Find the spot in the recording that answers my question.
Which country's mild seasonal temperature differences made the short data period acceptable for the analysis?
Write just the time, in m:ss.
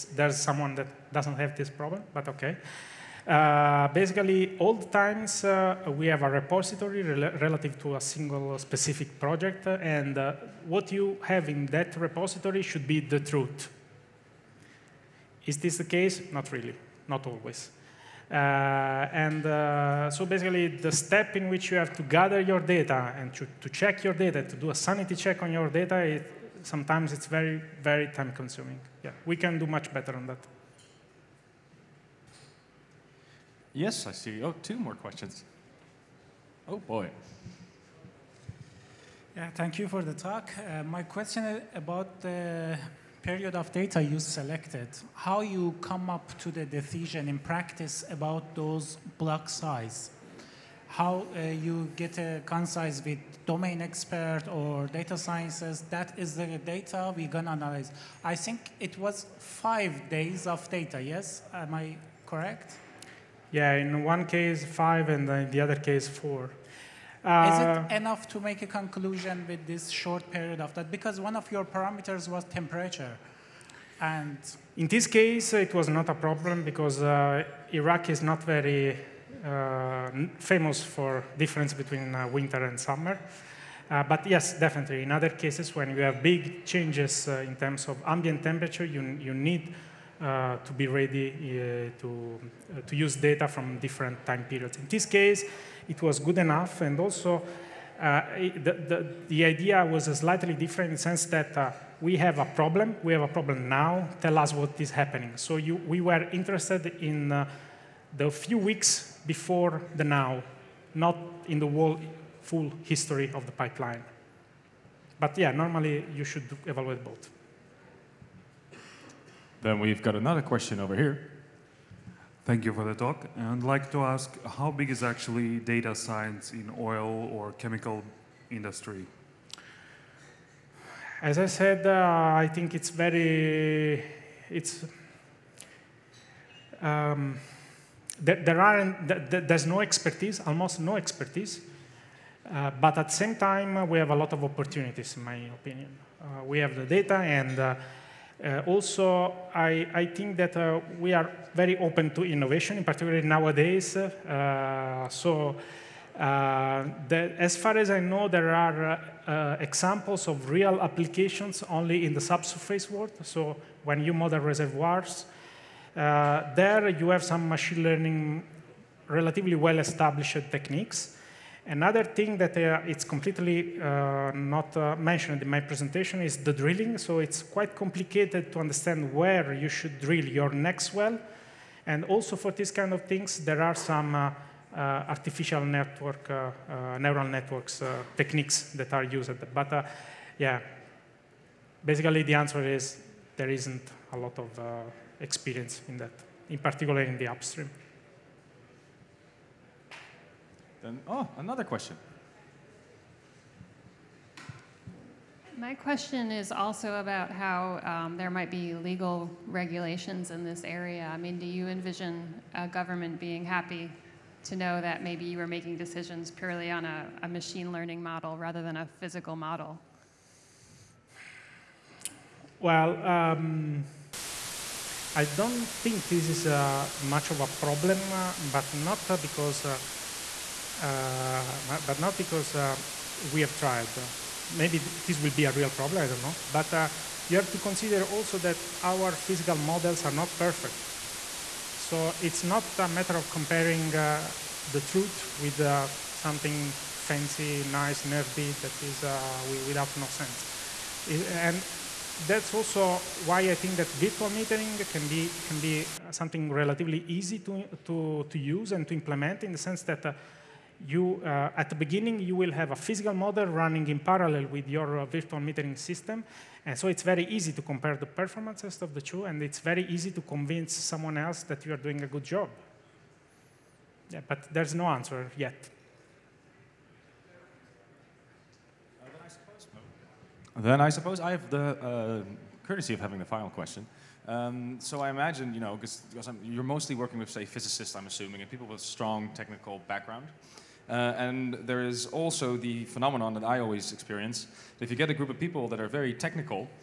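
1:17.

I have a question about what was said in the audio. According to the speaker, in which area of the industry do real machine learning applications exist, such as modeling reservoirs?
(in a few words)
Subsurface.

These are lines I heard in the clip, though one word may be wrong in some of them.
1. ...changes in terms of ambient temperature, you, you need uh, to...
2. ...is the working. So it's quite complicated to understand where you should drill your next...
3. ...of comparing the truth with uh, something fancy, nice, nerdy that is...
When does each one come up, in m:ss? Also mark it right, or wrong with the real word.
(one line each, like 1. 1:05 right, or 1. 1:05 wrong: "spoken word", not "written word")
1. 1:26 right
2. 2:56 wrong: "drilling", not "working"
3. 4:03 right.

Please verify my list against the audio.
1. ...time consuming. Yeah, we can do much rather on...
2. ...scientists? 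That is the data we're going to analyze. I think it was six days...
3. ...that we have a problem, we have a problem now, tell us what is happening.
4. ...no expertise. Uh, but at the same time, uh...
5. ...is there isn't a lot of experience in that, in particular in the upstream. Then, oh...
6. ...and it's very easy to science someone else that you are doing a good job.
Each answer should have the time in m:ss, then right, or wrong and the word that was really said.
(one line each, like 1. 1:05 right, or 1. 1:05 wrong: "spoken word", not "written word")
1. 0:28 wrong: "better", not "rather"
2. 0:55 wrong: "five", not "six"
3. 1:41 right
4. 2:20 right
5. 3:12 right
6. 4:29 wrong: "convince", not "science".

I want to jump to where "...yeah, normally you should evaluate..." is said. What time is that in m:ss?
1:55.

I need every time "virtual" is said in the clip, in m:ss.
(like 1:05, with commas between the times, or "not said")
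4:13, 4:25.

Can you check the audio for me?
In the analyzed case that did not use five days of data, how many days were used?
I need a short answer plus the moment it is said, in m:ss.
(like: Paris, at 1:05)
4, at 1:06.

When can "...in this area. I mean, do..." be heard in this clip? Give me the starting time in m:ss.
3:30.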